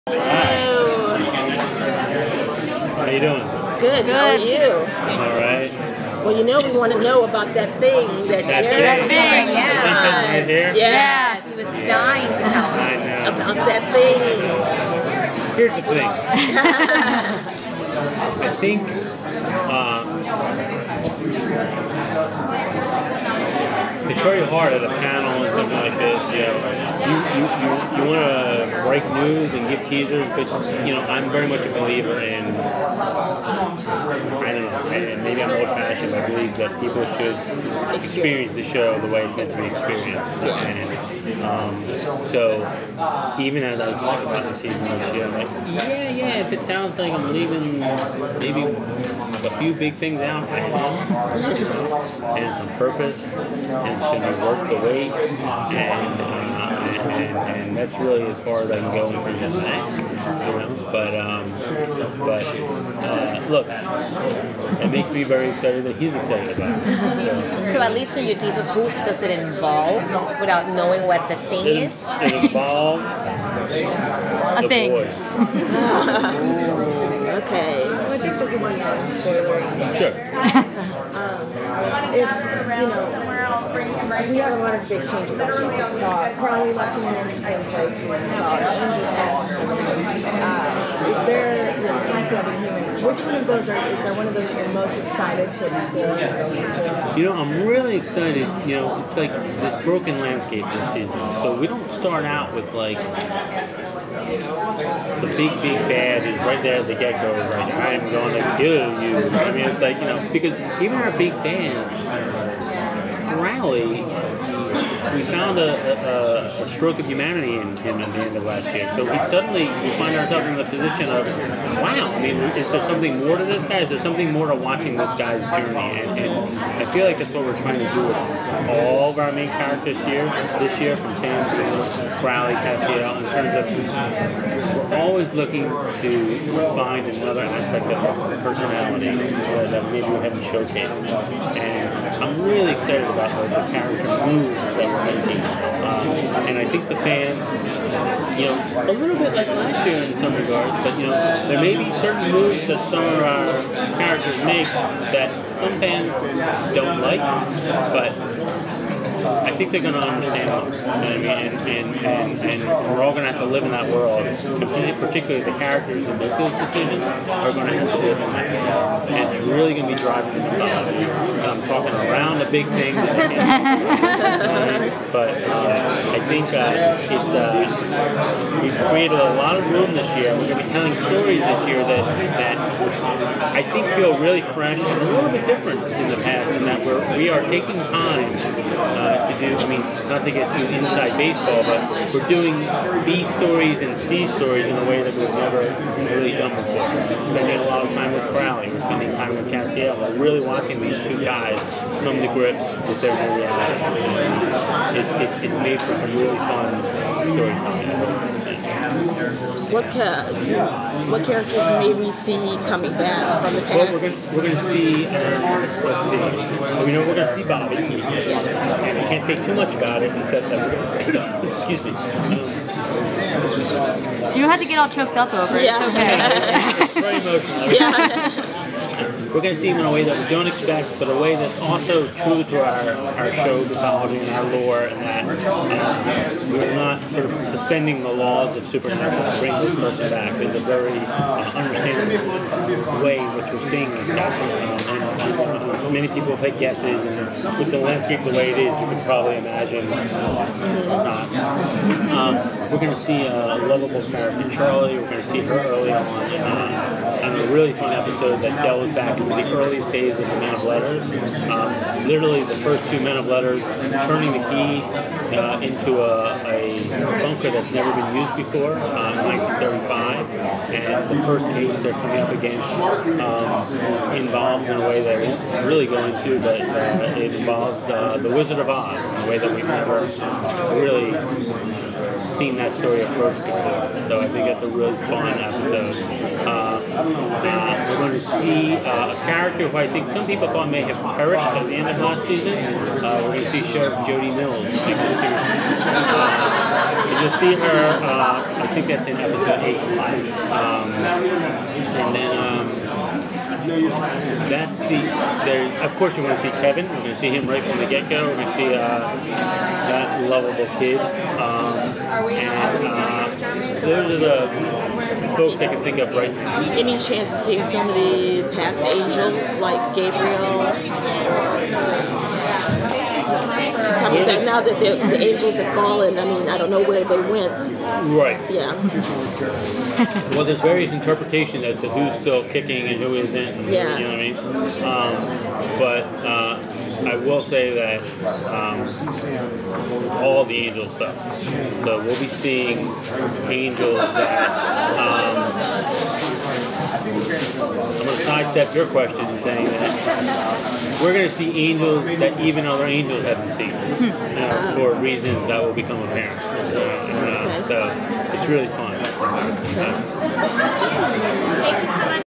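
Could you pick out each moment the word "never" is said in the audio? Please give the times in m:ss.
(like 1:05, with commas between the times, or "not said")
3:15, 4:27, 4:39.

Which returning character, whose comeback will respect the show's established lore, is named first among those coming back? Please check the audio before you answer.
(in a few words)
Bobby.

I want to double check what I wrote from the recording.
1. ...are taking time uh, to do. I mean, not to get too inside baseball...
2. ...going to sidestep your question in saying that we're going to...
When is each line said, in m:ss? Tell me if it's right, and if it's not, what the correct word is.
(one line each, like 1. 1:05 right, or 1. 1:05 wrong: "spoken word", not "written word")
1. 3:07 right
2. 5:47 right.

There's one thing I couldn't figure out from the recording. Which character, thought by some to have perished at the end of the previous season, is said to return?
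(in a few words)
Sheriff Jody Mills.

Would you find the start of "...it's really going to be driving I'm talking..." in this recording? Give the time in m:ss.
2:49.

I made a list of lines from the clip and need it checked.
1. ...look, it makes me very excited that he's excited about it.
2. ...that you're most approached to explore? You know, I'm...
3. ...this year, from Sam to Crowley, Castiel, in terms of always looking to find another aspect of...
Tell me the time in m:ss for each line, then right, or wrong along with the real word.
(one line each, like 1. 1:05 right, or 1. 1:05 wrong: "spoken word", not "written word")
1. 1:03 right
2. 1:34 wrong: "excited", not "approached"
3. 2:10 right.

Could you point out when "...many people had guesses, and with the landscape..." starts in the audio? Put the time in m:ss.
4:05.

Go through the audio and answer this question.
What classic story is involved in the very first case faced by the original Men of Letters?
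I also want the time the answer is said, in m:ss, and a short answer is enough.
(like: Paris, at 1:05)
The Wizard of Oz, at 4:38.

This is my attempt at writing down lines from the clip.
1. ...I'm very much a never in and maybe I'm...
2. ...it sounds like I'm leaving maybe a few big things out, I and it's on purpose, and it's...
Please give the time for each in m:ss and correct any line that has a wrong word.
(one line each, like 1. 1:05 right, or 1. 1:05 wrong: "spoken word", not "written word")
1. 0:31 wrong: "believer", not "never"
2. 0:46 right.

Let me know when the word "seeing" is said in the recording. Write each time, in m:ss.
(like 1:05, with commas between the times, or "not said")
4:03, 5:17, 5:42.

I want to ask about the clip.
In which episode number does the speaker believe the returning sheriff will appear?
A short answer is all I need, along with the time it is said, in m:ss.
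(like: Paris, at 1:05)
8, at 4:59.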